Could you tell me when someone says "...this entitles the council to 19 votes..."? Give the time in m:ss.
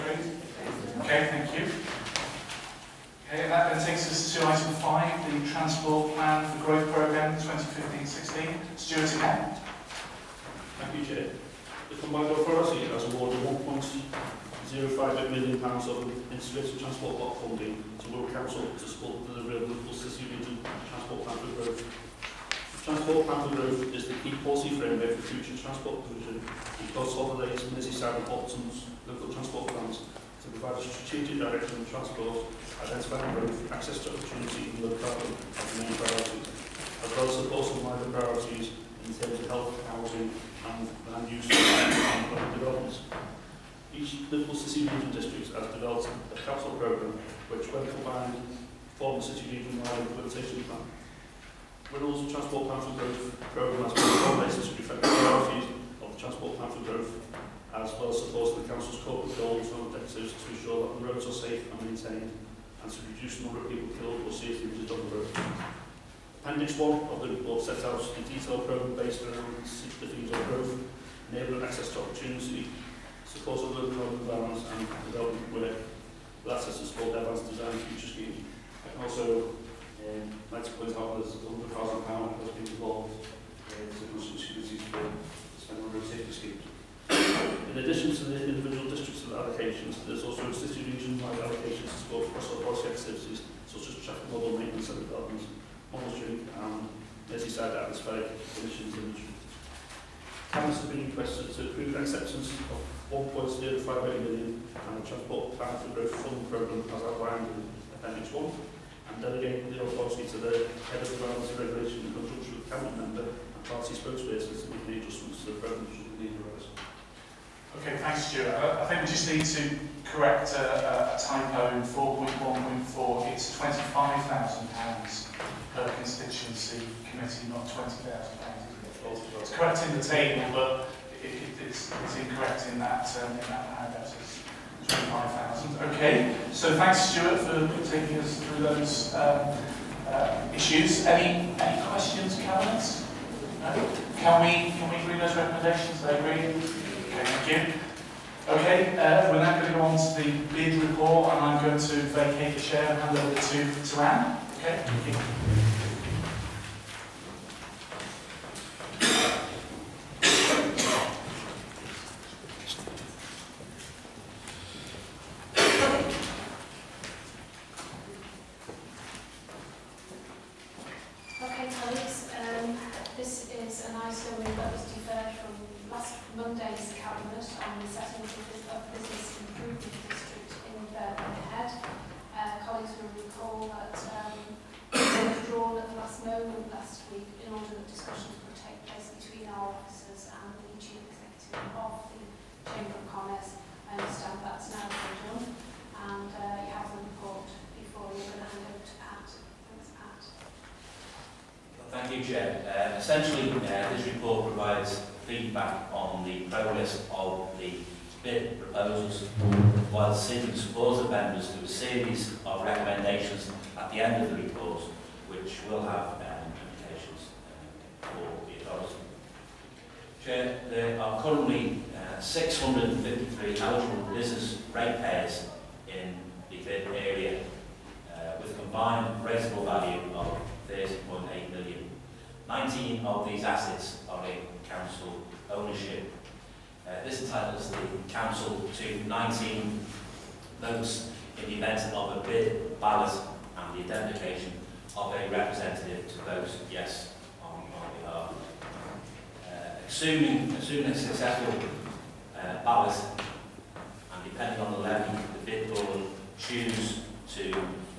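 3:57.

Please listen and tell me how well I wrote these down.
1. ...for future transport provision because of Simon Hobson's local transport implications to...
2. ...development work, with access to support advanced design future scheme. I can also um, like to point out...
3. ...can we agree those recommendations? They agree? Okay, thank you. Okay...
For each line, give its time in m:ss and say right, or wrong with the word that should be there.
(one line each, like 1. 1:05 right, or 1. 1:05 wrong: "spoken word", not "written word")
1. 0:25 wrong: "plans", not "implications"
2. 1:15 right
3. 2:24 right.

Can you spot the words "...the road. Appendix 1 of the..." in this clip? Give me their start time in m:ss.
1:05.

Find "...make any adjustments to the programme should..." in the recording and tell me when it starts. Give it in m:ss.
1:54.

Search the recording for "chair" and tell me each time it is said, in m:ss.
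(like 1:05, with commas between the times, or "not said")
0:11, 2:32, 3:40.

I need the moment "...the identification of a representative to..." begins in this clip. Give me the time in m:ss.
4:03.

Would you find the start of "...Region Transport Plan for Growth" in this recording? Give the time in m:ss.
0:20.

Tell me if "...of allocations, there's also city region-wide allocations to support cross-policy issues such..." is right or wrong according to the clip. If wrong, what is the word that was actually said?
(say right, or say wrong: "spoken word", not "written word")
wrong: "activities", not "issues".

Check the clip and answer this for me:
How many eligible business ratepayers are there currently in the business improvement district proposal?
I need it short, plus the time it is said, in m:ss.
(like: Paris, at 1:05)
653, at 3:42.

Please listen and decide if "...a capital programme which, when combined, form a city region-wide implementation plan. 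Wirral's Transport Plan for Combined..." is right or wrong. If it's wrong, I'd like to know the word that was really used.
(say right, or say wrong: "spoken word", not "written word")
wrong: "Growth", not "Combined".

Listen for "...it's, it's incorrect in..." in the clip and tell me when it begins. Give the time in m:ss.
2:11.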